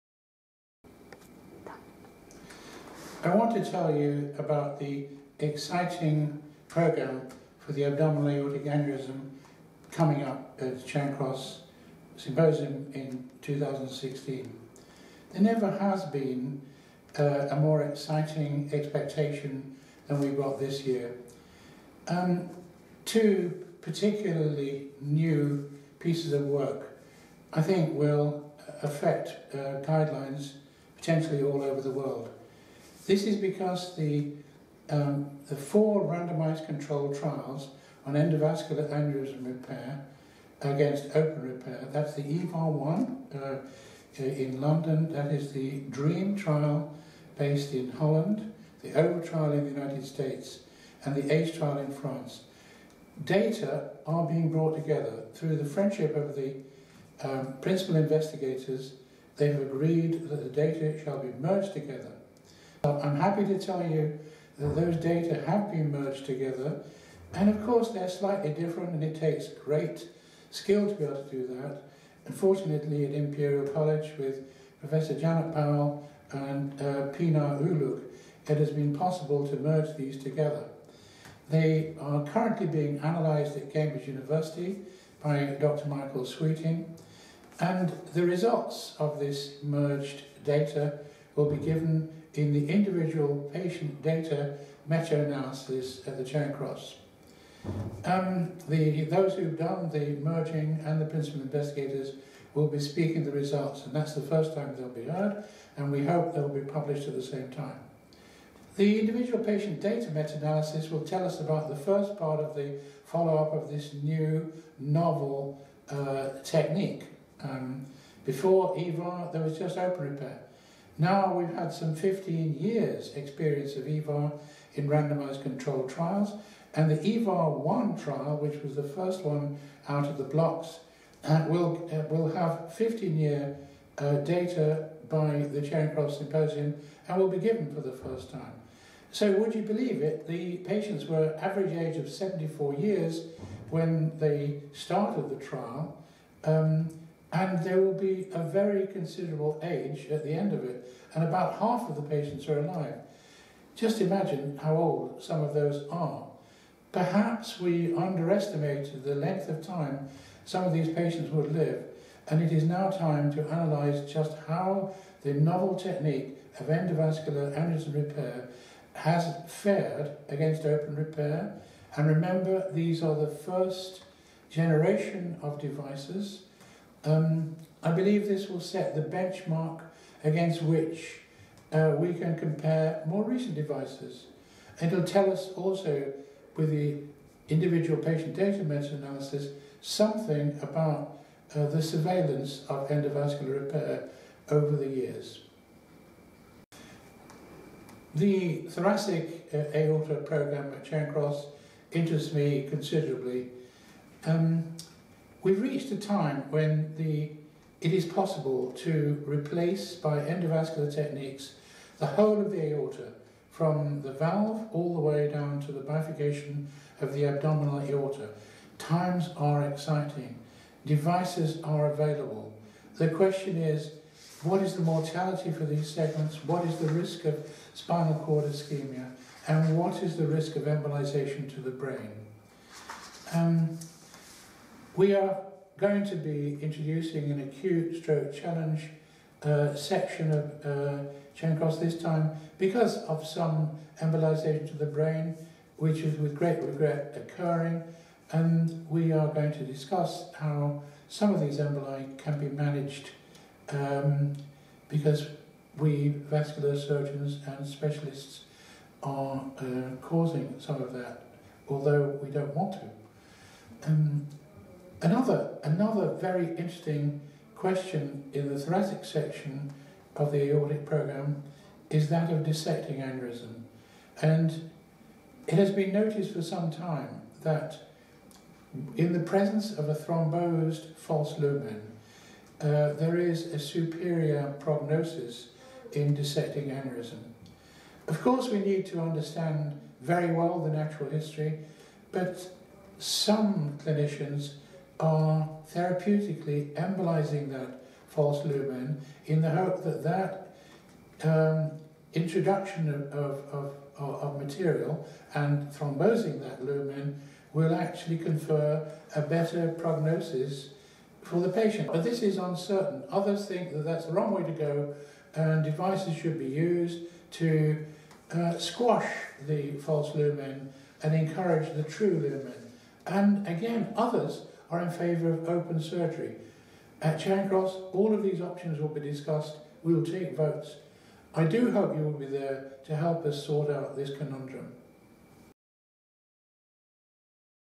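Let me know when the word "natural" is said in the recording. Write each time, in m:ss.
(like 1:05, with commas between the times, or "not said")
4:50.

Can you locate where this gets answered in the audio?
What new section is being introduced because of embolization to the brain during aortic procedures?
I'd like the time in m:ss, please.
3:57.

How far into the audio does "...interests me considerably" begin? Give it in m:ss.
3:21.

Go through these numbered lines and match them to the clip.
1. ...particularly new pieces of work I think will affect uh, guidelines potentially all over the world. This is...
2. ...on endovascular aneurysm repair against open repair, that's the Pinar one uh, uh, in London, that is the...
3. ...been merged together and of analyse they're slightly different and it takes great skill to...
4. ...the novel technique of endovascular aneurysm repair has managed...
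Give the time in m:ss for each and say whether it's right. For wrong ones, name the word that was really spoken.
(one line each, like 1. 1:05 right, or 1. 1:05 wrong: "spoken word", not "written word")
1. 0:23 right
2. 0:38 wrong: "EVAR", not "Pinar"
3. 1:05 wrong: "course", not "analyse"
4. 2:45 wrong: "fared", not "managed".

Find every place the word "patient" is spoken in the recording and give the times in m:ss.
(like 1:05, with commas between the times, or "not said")
1:33, 1:49, 2:20, 2:32, 2:40, 3:08, 5:11.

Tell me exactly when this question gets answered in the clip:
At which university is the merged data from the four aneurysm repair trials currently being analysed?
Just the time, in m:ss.
1:23.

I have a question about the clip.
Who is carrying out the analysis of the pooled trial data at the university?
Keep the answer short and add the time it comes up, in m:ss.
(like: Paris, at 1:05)
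Dr Michael Sweeting, at 1:25.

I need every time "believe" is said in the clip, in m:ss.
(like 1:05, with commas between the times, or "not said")
2:19, 2:57.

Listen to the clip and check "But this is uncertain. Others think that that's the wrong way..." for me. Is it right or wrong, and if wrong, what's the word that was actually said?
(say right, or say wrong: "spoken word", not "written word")
right.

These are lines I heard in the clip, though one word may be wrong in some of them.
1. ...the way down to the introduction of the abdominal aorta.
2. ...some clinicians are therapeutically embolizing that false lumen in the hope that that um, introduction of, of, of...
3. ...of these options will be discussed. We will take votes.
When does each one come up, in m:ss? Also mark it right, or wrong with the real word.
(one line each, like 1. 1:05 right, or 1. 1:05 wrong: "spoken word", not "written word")
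1. 3:34 wrong: "bifurcation", not "introduction"
2. 4:52 right
3. 5:28 right.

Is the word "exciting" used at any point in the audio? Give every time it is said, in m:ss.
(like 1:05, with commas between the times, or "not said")
0:05, 0:17, 3:39.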